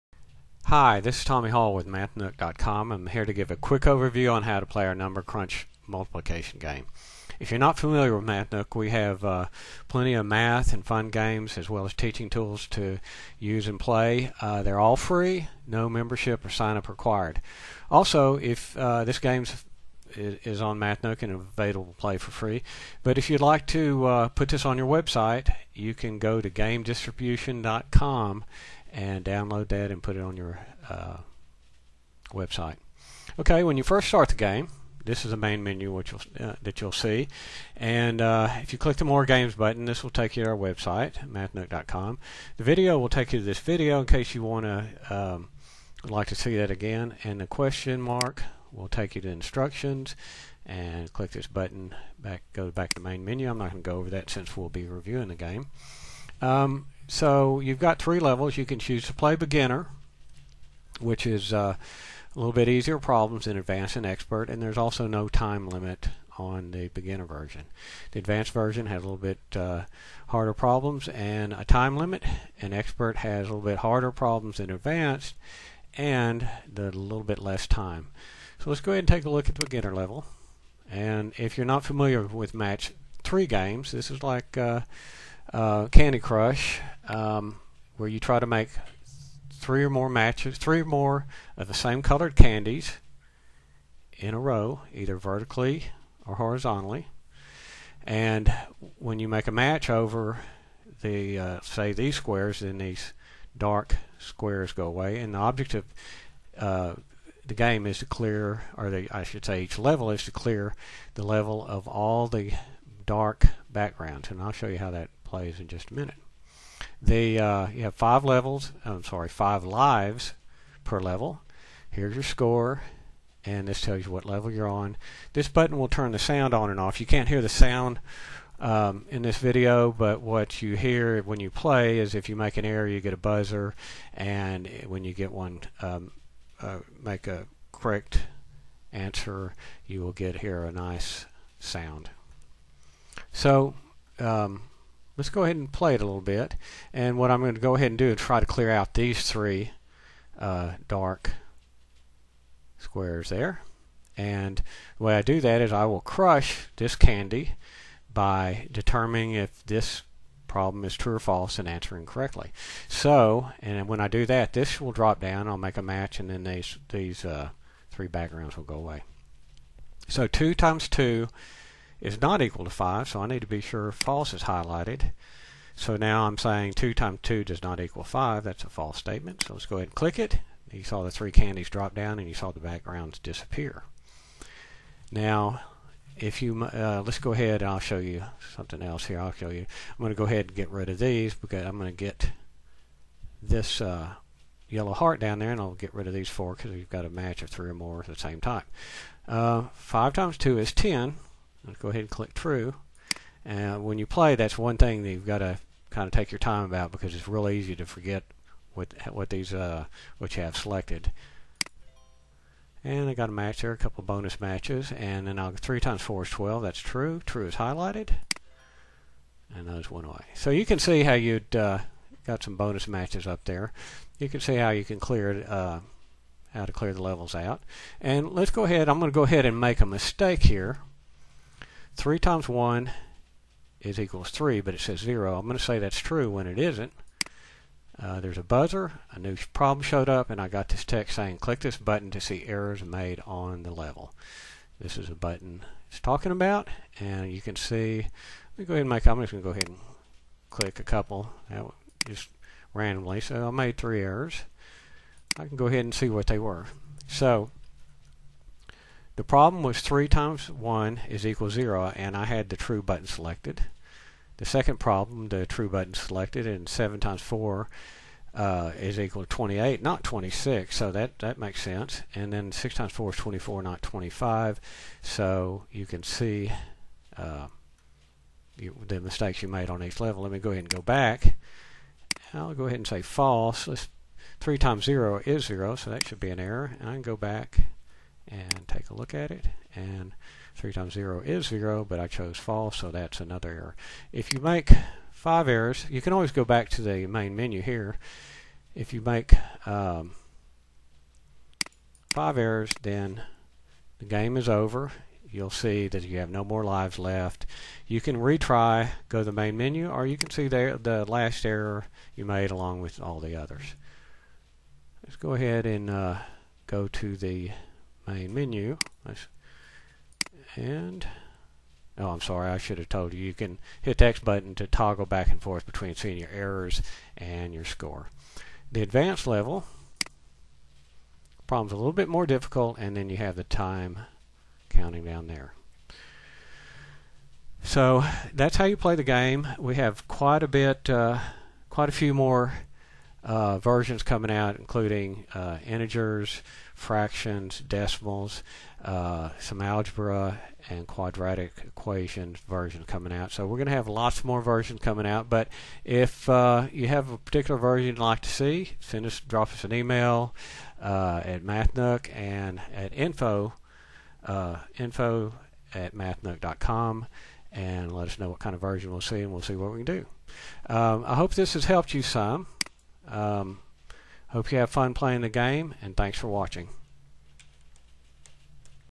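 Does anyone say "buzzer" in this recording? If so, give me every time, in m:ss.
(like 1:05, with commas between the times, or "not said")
2:13, 3:58.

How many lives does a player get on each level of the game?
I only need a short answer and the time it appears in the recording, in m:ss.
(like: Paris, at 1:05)
5, at 1:59.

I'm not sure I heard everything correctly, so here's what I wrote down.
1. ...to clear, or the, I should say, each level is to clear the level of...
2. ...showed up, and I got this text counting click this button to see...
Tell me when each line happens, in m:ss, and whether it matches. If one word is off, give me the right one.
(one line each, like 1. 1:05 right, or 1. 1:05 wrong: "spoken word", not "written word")
1. 1:47 right
2. 3:59 wrong: "saying", not "counting".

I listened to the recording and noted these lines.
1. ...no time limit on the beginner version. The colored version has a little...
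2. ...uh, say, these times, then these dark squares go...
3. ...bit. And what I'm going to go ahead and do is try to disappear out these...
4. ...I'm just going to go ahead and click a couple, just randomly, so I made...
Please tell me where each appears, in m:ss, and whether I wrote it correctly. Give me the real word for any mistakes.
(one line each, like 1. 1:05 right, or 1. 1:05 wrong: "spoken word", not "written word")
1. 1:05 wrong: "advanced", not "colored"
2. 1:41 wrong: "squares", not "times"
3. 2:26 wrong: "clear", not "disappear"
4. 4:09 right.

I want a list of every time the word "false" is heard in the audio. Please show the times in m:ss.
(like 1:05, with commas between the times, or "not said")
2:41, 2:53, 2:58, 4:43, 4:52.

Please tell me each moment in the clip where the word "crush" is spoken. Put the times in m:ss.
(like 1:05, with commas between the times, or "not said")
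1:26, 2:36.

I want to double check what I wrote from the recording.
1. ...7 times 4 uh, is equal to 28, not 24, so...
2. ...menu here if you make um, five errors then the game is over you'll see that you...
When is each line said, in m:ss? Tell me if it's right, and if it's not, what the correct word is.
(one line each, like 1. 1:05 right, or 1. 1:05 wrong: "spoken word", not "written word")
1. 4:26 wrong: "26", not "24"
2. 4:57 right.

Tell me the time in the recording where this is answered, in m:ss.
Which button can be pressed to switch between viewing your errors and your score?
5:24.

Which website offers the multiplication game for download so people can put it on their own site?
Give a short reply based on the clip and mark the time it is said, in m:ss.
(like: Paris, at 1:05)
gamedistribution.com, at 0:26.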